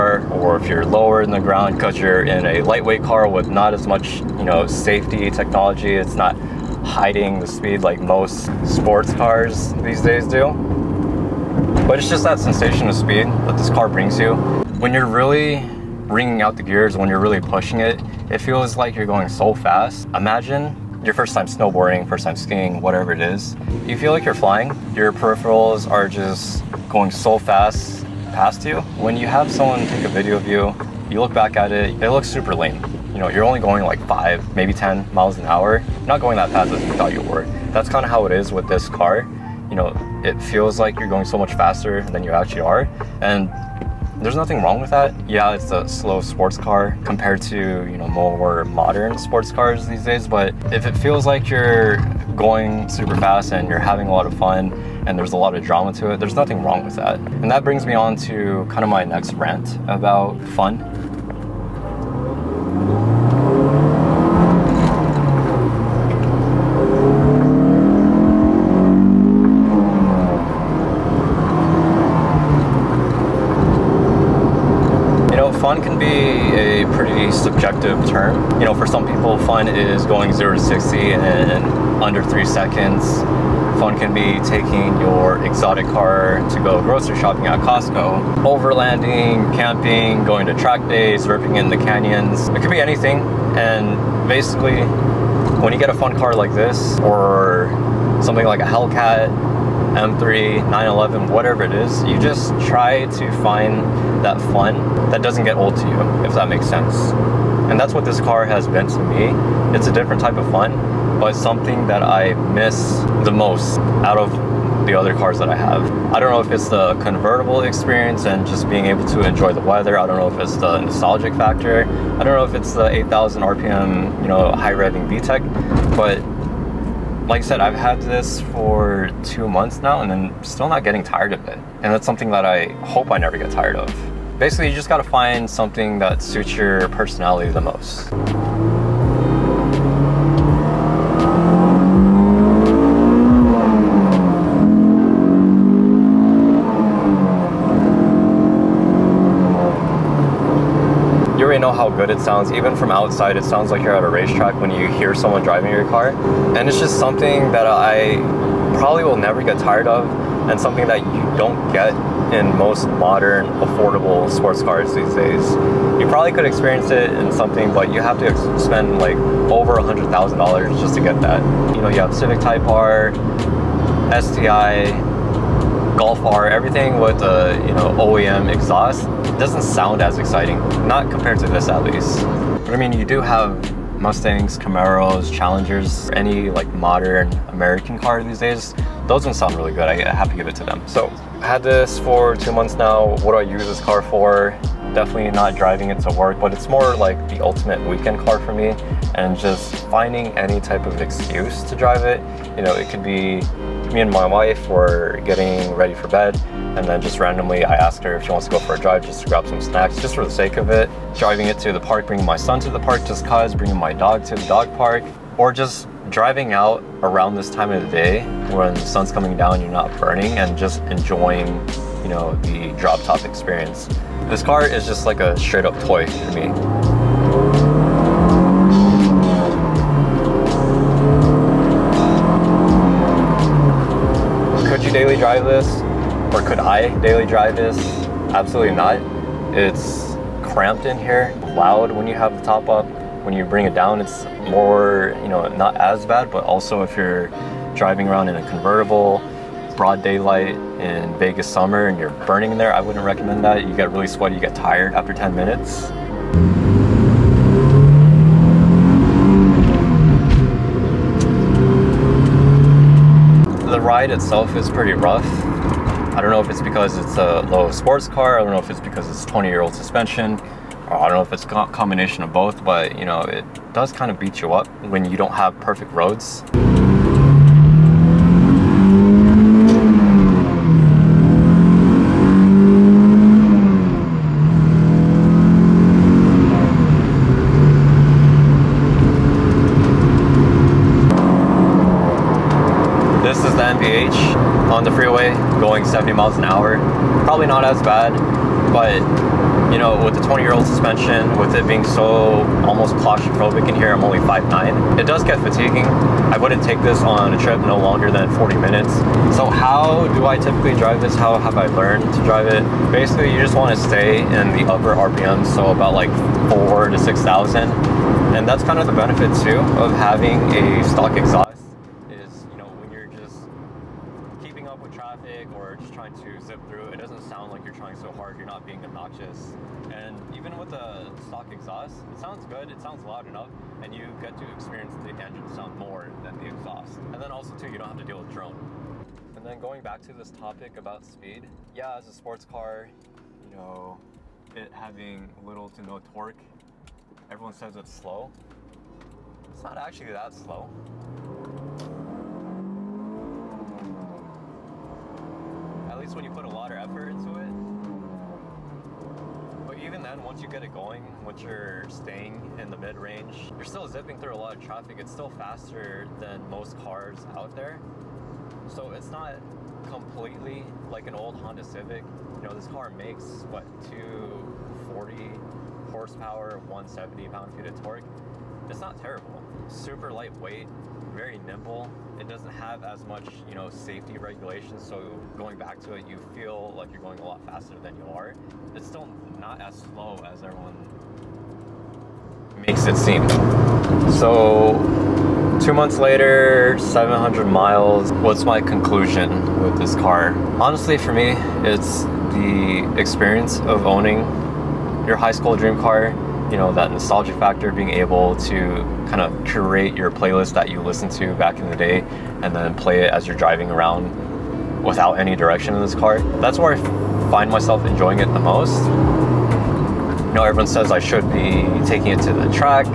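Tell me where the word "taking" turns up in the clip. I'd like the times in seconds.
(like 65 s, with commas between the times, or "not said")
84 s, 421 s.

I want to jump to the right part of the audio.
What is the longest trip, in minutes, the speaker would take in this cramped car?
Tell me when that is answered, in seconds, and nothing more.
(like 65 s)
308 s.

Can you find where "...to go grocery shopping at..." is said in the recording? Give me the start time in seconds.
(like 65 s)
86 s.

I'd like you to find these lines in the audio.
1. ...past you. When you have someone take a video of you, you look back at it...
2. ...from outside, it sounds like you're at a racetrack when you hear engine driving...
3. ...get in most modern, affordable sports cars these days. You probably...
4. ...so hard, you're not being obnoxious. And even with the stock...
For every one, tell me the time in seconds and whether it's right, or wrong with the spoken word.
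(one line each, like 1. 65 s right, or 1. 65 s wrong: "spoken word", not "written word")
1. 28 s right
2. 152 s wrong: "someone", not "engine"
3. 161 s right
4. 327 s right.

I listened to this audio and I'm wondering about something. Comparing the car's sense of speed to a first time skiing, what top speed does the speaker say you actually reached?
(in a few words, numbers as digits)
10 miles an hour.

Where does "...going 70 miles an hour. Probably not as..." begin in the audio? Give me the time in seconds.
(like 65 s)
295 s.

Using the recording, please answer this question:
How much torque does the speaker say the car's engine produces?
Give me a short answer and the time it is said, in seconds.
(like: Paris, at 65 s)
170 pound-feet, at 376 s.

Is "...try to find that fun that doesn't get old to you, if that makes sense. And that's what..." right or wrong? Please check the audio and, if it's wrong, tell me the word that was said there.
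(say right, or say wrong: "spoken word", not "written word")
right.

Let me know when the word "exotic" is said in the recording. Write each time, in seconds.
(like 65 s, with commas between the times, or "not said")
85 s.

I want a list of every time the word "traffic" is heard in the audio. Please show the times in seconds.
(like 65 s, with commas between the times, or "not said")
324 s, 364 s.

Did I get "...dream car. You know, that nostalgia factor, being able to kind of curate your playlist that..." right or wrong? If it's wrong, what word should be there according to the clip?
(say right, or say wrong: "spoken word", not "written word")
right.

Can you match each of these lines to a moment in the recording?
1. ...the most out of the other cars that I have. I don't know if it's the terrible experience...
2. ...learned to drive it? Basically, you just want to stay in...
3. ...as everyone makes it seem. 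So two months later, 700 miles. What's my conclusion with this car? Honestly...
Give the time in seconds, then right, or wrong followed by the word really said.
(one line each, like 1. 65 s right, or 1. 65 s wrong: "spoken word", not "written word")
1. 113 s wrong: "convertible", not "terrible"
2. 311 s right
3. 390 s right.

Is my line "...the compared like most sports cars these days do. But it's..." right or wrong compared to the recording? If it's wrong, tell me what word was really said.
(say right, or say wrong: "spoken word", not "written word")
wrong: "speed", not "compared".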